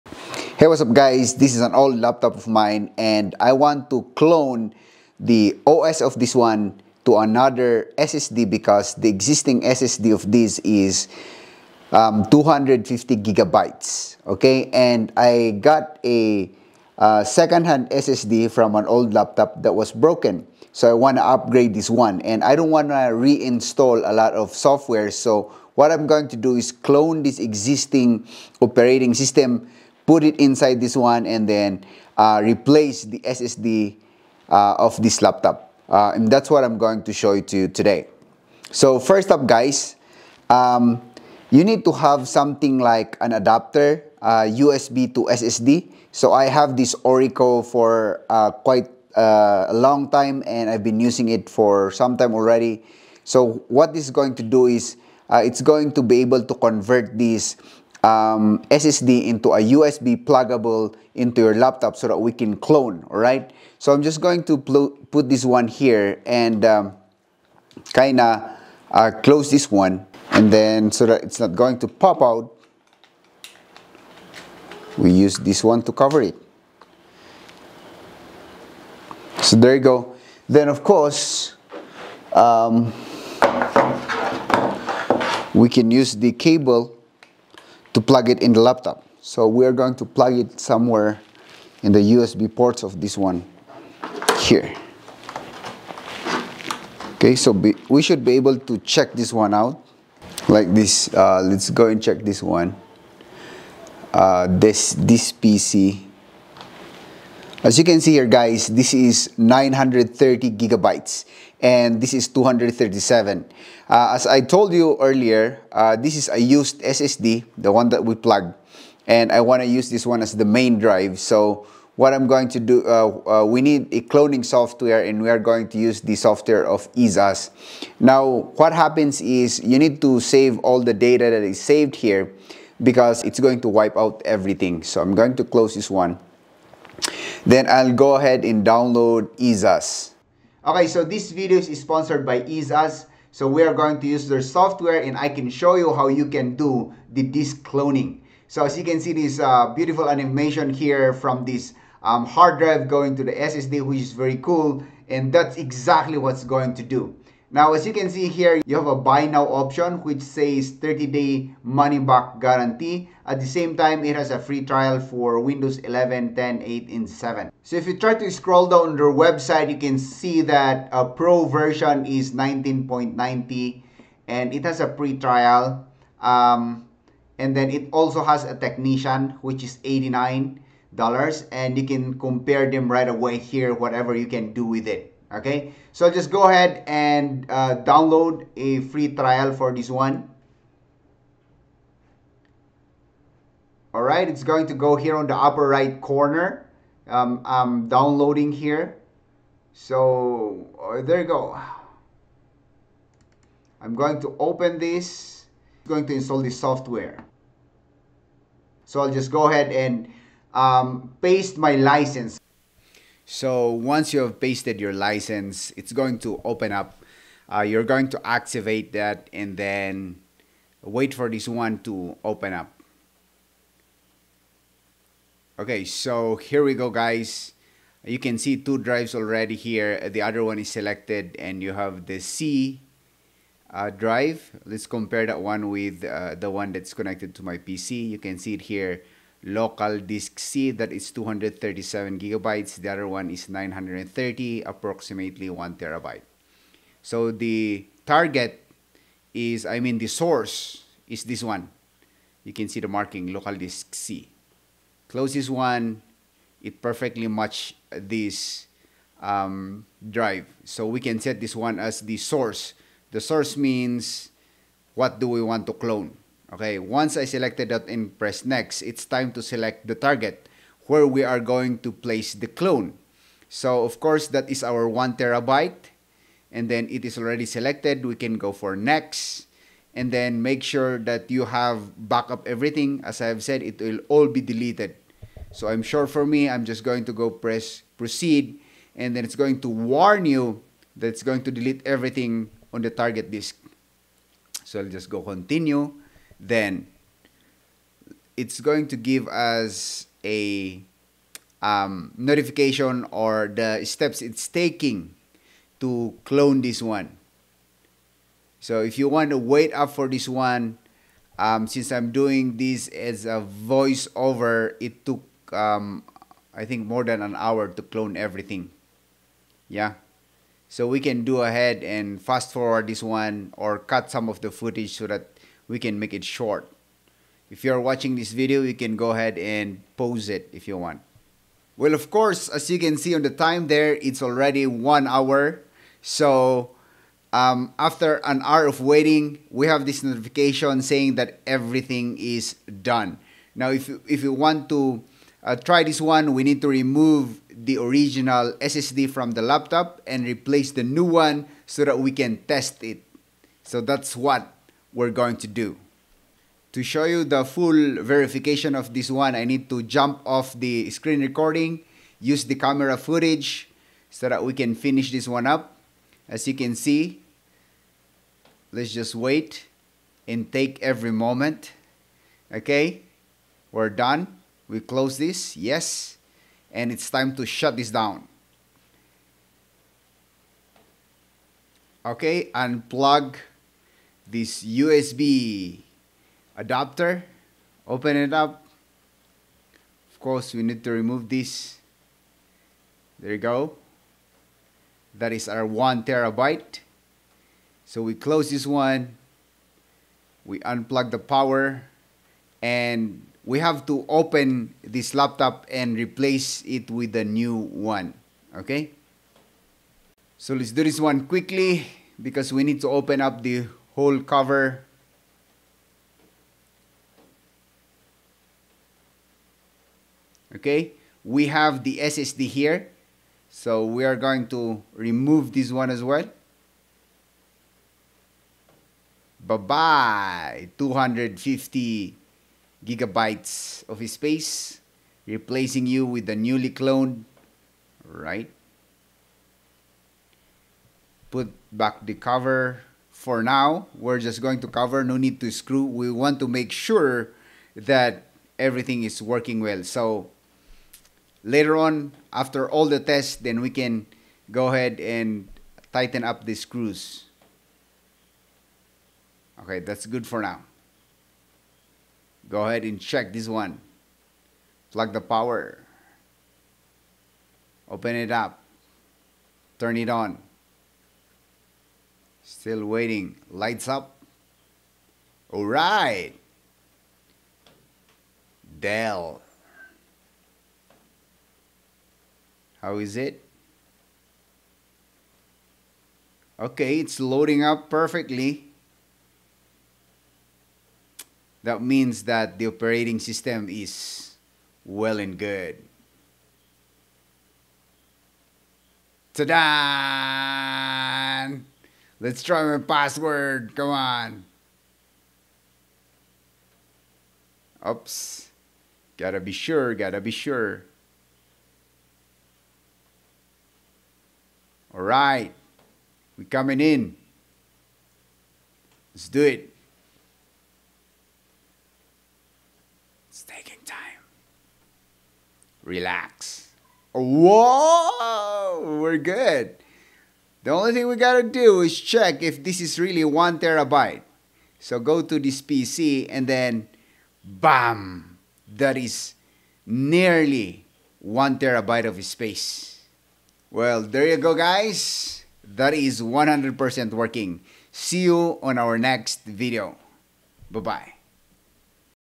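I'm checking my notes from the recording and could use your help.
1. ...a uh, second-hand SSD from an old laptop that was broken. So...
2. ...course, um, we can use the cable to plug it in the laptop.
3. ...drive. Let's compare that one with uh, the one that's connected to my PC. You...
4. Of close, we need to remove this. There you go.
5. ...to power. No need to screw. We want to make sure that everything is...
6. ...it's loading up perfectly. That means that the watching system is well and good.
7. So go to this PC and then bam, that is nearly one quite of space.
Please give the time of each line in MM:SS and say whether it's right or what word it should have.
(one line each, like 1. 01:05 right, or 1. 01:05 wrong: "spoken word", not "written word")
1. 00:16 right
2. 01:20 right
3. 03:53 right
4. 06:30 wrong: "course", not "close"
5. 07:24 wrong: "cover", not "power"
6. 08:06 wrong: "operating", not "watching"
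7. 08:54 wrong: "terabyte", not "quite".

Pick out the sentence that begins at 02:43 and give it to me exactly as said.
At the same time, it has a free trial for Windows 11, 10, 8, and 7.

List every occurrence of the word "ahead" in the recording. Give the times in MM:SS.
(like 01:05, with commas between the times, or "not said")
02:18, 03:06, 03:29, 05:21, 05:29, 07:34, 07:42.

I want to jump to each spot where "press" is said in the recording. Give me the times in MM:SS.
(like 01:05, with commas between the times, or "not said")
04:28, 04:47.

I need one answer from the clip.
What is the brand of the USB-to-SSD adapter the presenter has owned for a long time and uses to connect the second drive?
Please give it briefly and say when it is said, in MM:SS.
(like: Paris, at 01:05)
Orico, at 00:47.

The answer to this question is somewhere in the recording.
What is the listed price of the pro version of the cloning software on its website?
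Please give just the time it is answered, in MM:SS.
02:52.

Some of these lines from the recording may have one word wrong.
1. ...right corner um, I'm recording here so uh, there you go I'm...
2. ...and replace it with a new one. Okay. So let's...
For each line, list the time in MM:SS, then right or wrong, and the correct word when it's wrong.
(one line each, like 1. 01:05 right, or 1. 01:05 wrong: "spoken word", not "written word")
1. 03:15 wrong: "downloading", not "recording"
2. 06:45 right.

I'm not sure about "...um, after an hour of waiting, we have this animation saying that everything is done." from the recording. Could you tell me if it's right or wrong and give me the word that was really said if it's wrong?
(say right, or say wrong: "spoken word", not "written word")
wrong: "notification", not "animation".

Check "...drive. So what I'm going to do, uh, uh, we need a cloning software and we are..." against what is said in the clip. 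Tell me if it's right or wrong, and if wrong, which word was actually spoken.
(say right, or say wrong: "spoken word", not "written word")
right.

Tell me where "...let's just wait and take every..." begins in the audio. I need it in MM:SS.
06:08.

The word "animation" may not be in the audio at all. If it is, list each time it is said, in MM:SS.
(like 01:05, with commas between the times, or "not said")
02:30.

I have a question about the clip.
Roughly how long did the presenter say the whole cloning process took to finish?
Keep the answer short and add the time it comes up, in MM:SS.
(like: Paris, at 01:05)
more than an hour, at 05:16.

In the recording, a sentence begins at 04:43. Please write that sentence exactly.
As I have said, it will all be deleted.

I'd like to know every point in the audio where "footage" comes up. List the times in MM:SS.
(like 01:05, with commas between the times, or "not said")
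05:24, 06:02.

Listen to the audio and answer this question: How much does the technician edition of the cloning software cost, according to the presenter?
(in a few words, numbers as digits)
89 dollars.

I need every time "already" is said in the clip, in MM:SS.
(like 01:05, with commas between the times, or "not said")
00:52, 03:49, 04:37, 05:34.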